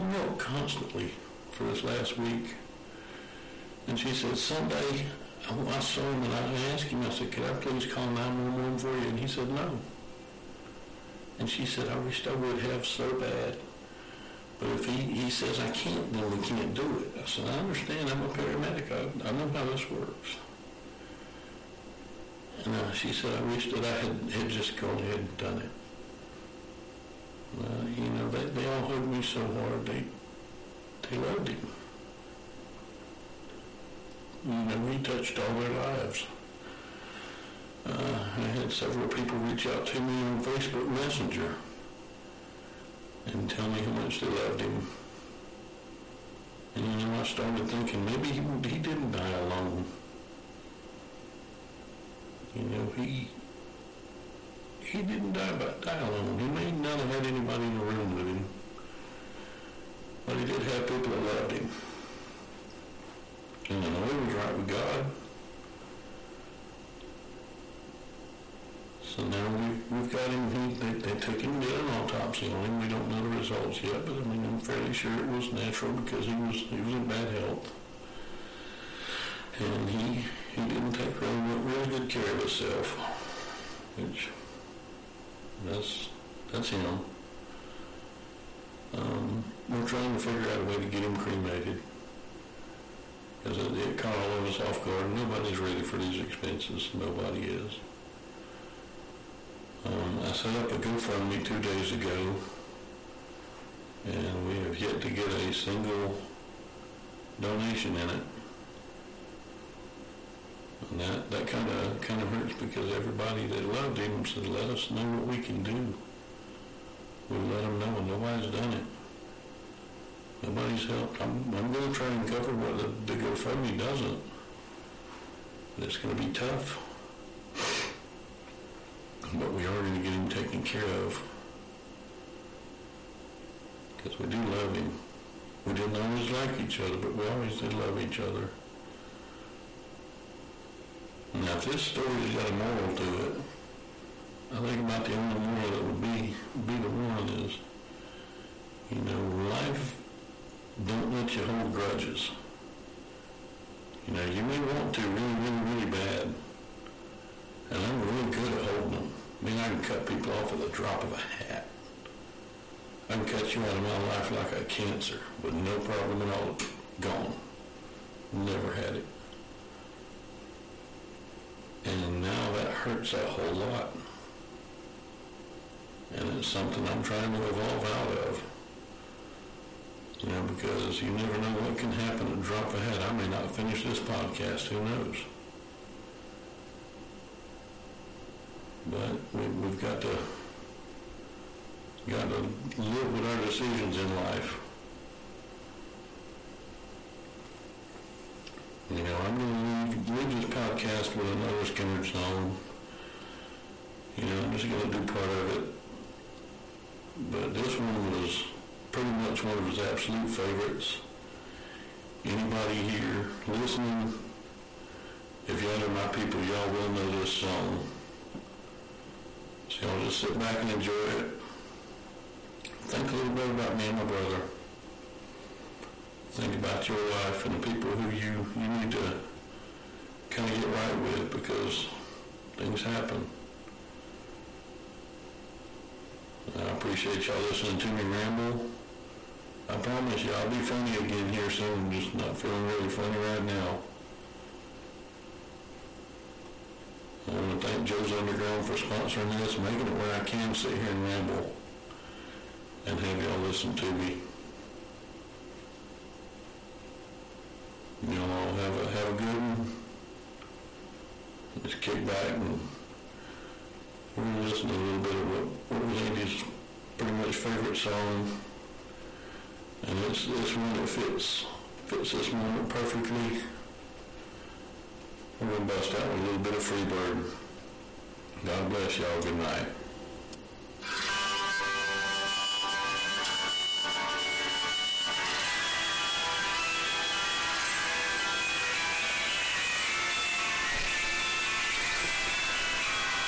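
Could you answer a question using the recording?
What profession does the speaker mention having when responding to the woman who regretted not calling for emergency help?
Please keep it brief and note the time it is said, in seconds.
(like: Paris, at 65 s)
Paramedic, at 18 s.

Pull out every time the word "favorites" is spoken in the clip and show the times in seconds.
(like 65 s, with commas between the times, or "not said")
210 s, 267 s.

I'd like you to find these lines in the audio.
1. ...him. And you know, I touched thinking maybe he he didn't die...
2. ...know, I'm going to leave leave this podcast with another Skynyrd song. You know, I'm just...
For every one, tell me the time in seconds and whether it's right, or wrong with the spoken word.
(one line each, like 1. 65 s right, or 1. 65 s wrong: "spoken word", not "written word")
1. 44 s wrong: "started", not "touched"
2. 199 s right.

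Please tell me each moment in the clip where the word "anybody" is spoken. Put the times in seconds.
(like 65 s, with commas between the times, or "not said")
57 s, 212 s.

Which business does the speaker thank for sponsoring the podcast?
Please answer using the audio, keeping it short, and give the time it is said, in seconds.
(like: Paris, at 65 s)
Joe's Underground, at 247 s.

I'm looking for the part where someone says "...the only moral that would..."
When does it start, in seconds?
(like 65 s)
145 s.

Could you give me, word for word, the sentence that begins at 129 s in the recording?
But we are going to get him taken care of.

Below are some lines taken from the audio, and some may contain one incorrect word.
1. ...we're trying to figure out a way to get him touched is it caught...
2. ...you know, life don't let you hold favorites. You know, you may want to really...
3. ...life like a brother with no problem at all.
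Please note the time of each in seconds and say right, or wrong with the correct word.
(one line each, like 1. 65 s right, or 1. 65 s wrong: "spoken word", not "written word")
1. 89 s wrong: "cremated", not "touched"
2. 148 s wrong: "grudges", not "favorites"
3. 163 s wrong: "cancer", not "brother".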